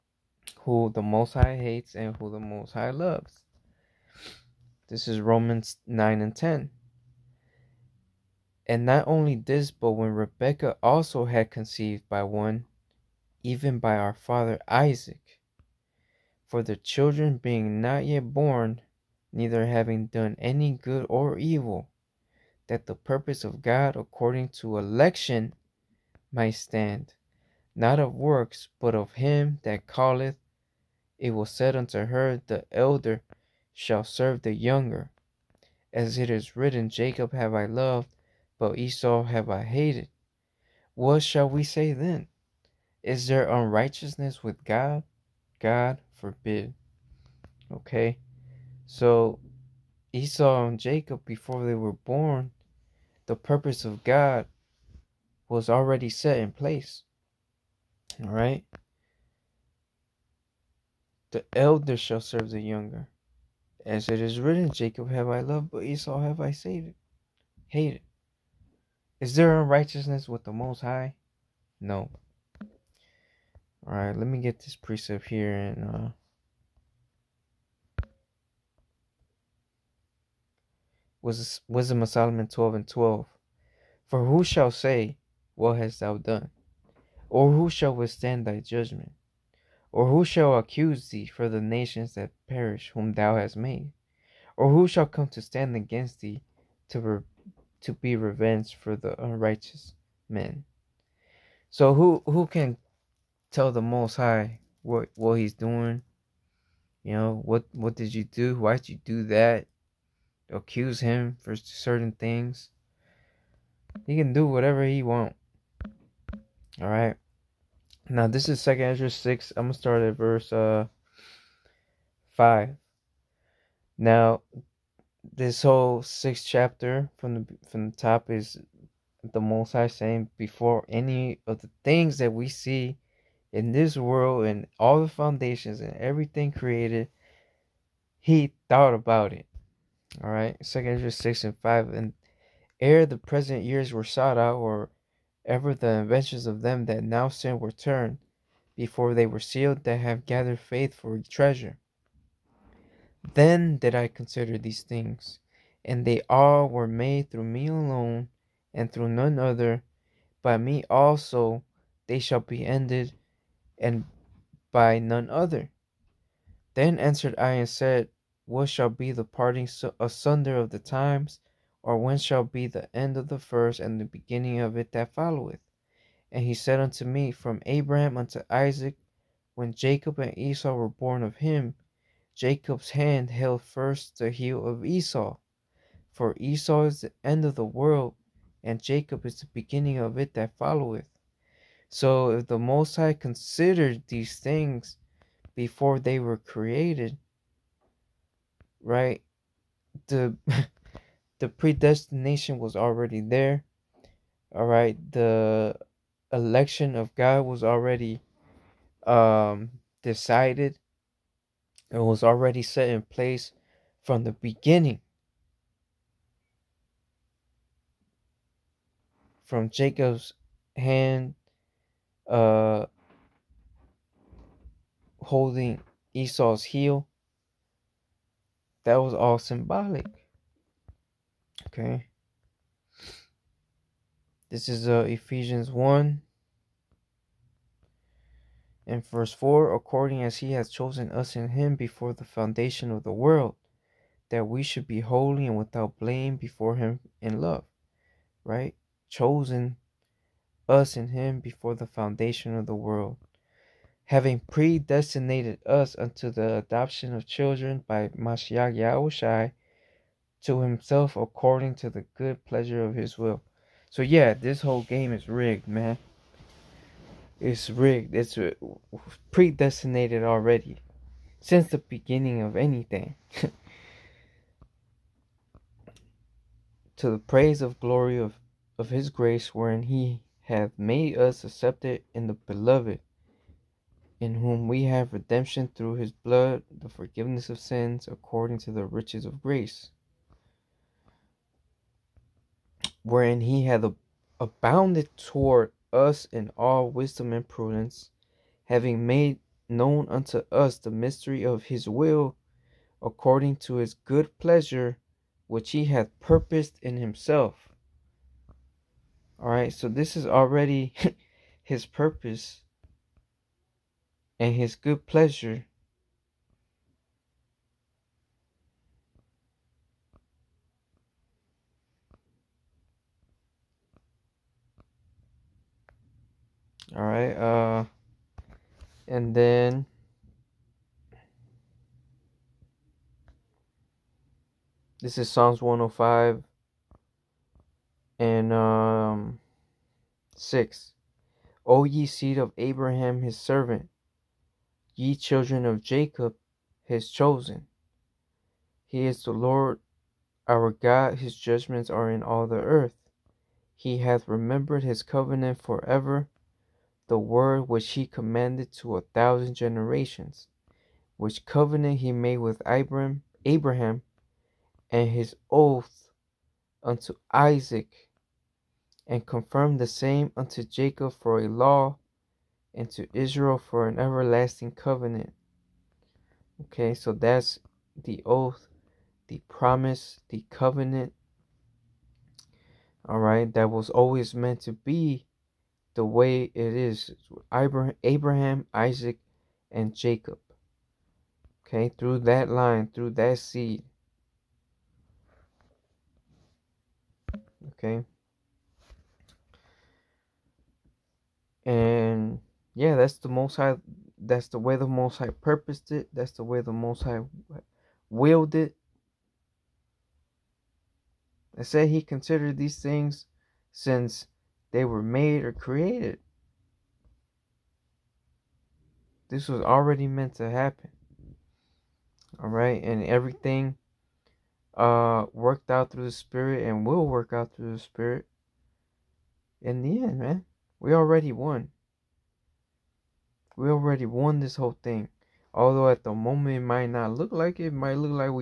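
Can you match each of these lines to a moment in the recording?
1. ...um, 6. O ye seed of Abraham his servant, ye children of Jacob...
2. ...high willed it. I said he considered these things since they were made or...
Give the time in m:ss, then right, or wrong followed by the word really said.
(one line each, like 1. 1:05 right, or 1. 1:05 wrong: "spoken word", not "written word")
1. 5:38 right
2. 6:47 right.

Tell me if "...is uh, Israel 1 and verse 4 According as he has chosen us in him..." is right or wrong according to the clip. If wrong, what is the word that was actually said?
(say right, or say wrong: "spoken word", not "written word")
wrong: "Ephesians", not "Israel".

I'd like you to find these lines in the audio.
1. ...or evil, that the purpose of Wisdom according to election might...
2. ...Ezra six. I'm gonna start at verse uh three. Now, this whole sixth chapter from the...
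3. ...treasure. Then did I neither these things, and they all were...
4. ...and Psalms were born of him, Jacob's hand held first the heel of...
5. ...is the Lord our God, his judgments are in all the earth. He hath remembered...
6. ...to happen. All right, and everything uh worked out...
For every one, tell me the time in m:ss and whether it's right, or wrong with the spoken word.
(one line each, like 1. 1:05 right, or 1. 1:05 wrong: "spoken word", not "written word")
1. 0:21 wrong: "God", not "Wisdom"
2. 1:58 wrong: "five", not "three"
3. 2:31 wrong: "consider", not "neither"
4. 3:00 wrong: "Esau", not "Psalms"
5. 5:49 right
6. 7:00 right.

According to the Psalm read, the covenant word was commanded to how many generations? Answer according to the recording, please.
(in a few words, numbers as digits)
1000.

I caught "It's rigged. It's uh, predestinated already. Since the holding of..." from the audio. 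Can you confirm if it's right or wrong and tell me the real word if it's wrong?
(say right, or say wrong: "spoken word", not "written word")
wrong: "beginning", not "holding".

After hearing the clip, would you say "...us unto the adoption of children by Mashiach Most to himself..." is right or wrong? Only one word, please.
wrong.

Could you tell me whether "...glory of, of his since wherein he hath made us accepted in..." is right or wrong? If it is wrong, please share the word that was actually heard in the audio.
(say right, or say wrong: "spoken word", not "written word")
wrong: "grace", not "since".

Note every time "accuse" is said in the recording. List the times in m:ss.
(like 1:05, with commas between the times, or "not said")
1:30, 1:50.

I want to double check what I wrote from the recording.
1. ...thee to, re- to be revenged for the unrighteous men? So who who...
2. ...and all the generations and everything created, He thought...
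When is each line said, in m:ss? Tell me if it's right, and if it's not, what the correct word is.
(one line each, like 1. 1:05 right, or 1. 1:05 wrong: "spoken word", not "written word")
1. 1:36 right
2. 2:14 wrong: "foundations", not "generations".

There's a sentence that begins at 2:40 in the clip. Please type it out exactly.
By me also they shall be ended, and by none other.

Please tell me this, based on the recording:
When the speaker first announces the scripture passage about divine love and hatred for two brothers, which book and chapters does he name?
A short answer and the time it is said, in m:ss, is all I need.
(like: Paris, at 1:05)
Romans 9 and 10, at 0:05.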